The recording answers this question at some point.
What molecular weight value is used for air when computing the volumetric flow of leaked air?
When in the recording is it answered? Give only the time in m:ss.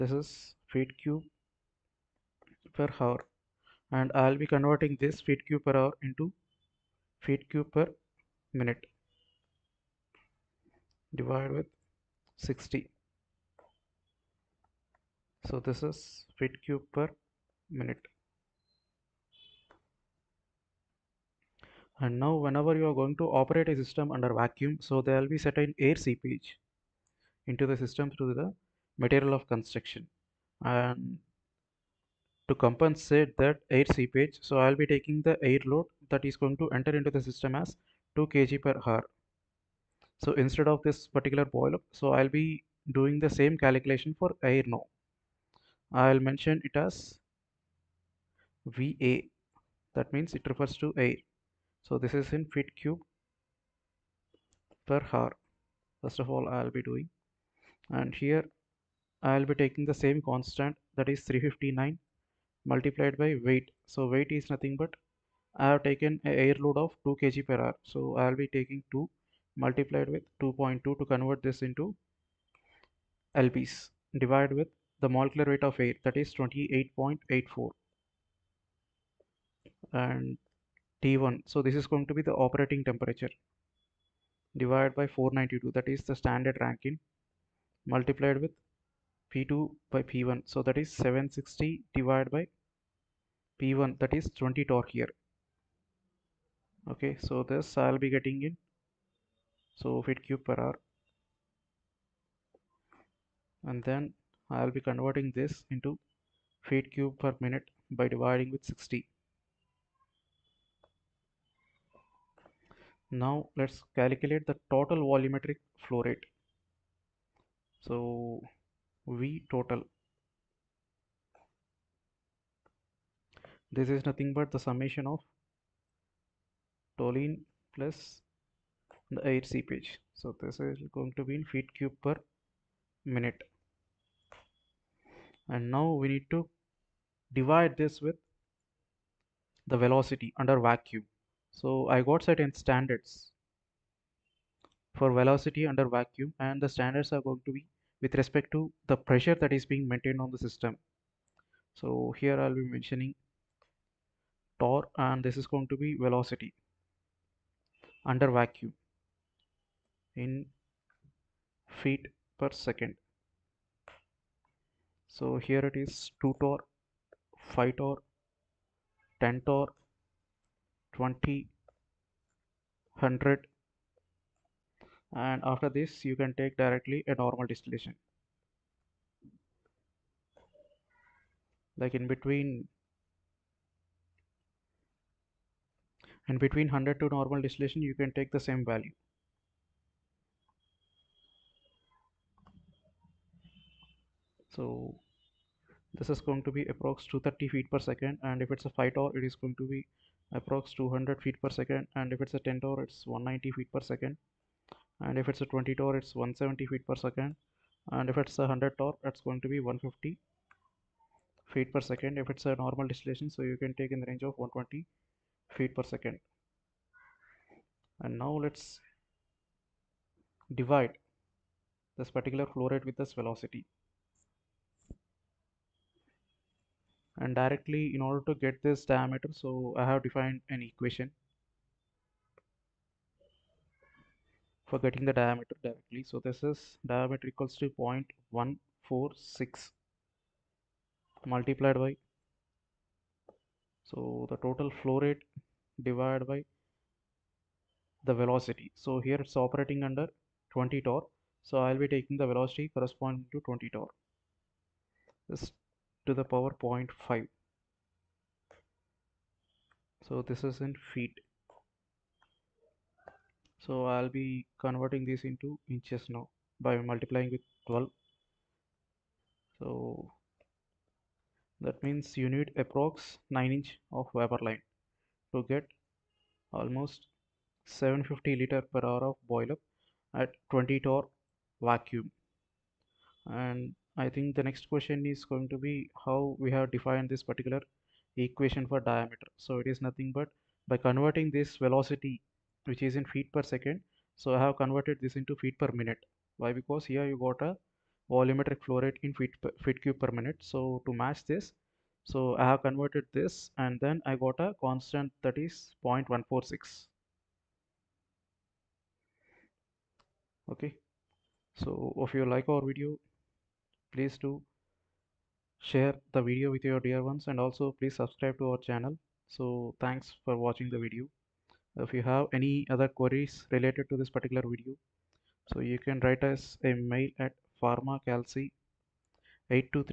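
1:16.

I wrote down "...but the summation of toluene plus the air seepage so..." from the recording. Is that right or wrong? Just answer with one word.
right.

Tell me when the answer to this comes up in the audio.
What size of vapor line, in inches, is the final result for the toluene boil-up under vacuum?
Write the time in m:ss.
4:33.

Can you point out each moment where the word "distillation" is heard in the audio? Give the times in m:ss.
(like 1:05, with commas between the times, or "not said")
2:57, 3:07, 3:32.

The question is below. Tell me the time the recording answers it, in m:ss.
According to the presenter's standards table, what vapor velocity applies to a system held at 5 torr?
3:20.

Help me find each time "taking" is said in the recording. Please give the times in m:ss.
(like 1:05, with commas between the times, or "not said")
0:34, 0:59, 1:08, 4:11.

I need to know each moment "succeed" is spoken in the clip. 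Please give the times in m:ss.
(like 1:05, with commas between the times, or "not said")
not said.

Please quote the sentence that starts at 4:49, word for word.
So it is nothing but by converting this velocity which is in feet per second.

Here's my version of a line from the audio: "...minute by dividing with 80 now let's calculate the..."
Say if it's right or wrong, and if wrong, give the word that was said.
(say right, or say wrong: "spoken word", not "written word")
wrong: "60", not "80".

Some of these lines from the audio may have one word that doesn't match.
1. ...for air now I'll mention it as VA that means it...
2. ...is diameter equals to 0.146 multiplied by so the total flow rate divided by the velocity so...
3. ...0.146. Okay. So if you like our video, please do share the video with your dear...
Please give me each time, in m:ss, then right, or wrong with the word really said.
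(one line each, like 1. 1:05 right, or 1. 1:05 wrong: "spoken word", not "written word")
1. 0:44 right
2. 3:56 right
3. 5:05 right.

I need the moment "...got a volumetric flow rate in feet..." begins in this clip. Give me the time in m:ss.
4:57.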